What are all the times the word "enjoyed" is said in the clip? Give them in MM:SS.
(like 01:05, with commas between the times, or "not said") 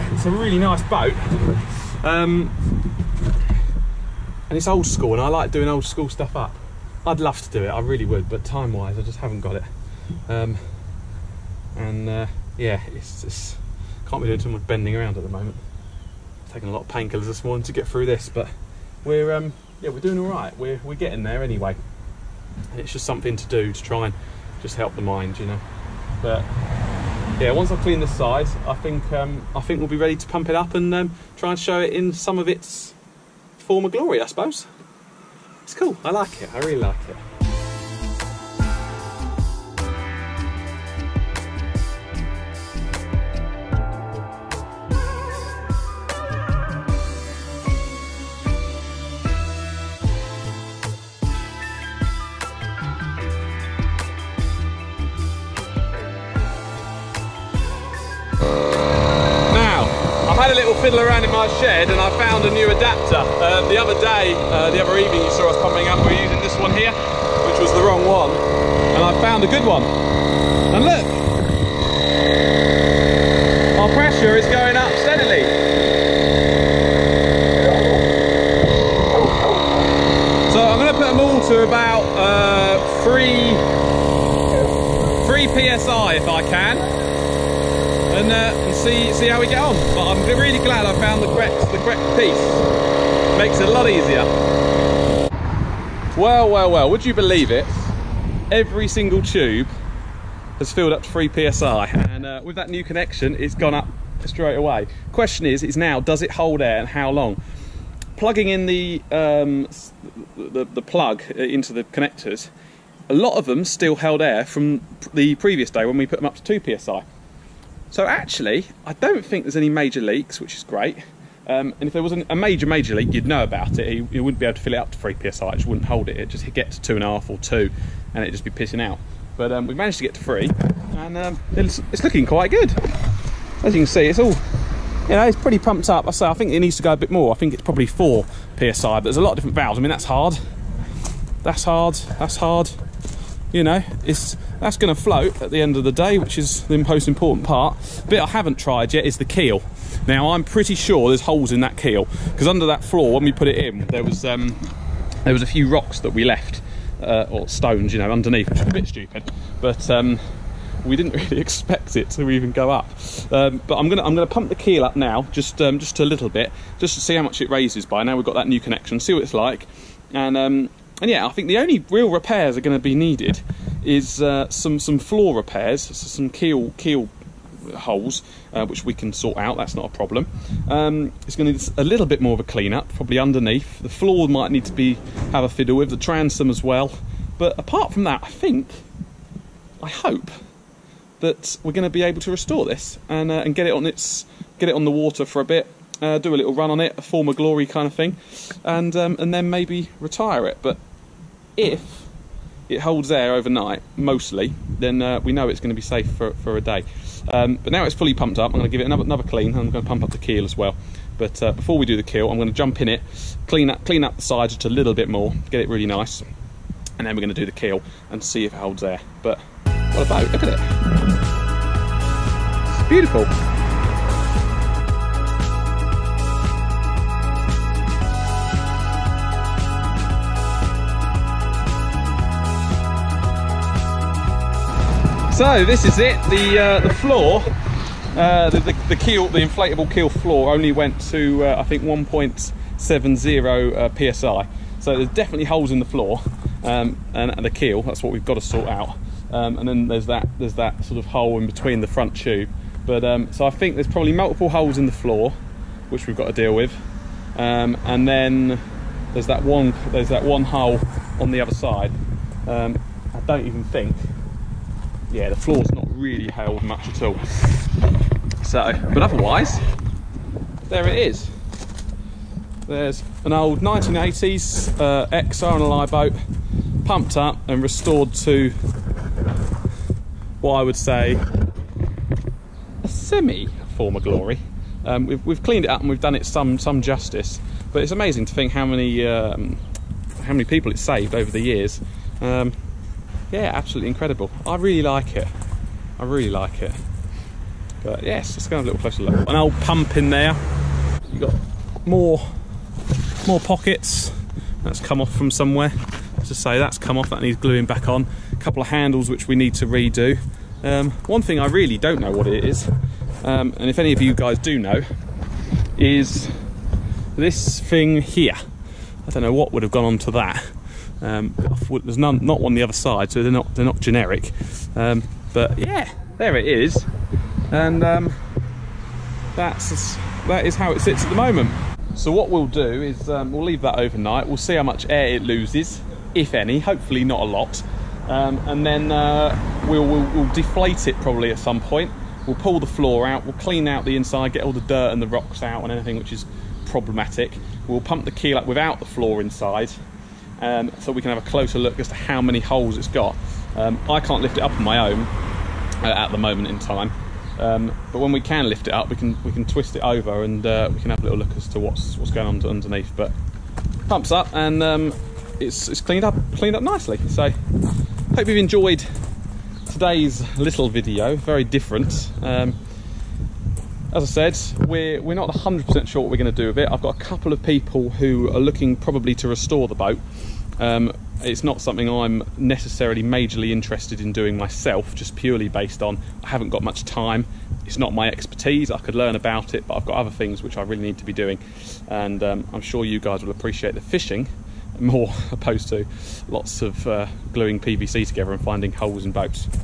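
06:08.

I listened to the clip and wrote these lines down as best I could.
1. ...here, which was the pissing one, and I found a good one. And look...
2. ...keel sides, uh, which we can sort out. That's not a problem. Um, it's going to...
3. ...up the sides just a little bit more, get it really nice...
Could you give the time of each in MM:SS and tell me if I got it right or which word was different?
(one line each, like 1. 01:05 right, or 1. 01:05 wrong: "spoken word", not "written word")
1. 01:06 wrong: "wrong", not "pissing"
2. 02:56 wrong: "holes", not "sides"
3. 03:34 right.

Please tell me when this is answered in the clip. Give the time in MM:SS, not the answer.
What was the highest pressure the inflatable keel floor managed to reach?
04:01.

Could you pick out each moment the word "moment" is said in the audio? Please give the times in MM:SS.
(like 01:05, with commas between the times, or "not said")
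00:15, 05:31, 05:56.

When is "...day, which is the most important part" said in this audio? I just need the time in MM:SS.
02:25.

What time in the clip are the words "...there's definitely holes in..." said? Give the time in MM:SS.
04:04.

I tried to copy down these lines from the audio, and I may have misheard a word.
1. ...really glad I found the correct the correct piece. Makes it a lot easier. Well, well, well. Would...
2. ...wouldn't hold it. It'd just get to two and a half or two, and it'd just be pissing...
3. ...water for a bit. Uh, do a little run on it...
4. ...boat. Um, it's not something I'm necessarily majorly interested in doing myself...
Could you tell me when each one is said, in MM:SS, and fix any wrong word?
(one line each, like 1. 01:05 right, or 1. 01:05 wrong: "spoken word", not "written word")
1. 01:30 right
2. 02:05 right
3. 03:14 right
4. 06:19 right.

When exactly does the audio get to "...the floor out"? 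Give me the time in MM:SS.
05:42.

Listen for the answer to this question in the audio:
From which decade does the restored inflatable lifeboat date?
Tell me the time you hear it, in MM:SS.
04:33.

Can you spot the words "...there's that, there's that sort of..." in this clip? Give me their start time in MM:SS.
04:09.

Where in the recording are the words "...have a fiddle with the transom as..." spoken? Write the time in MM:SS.
03:05.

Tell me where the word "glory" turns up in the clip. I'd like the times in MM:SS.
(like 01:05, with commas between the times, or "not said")
00:33, 03:17, 04:43.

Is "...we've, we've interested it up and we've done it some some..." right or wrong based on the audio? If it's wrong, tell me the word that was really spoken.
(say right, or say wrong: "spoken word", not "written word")
wrong: "cleaned", not "interested".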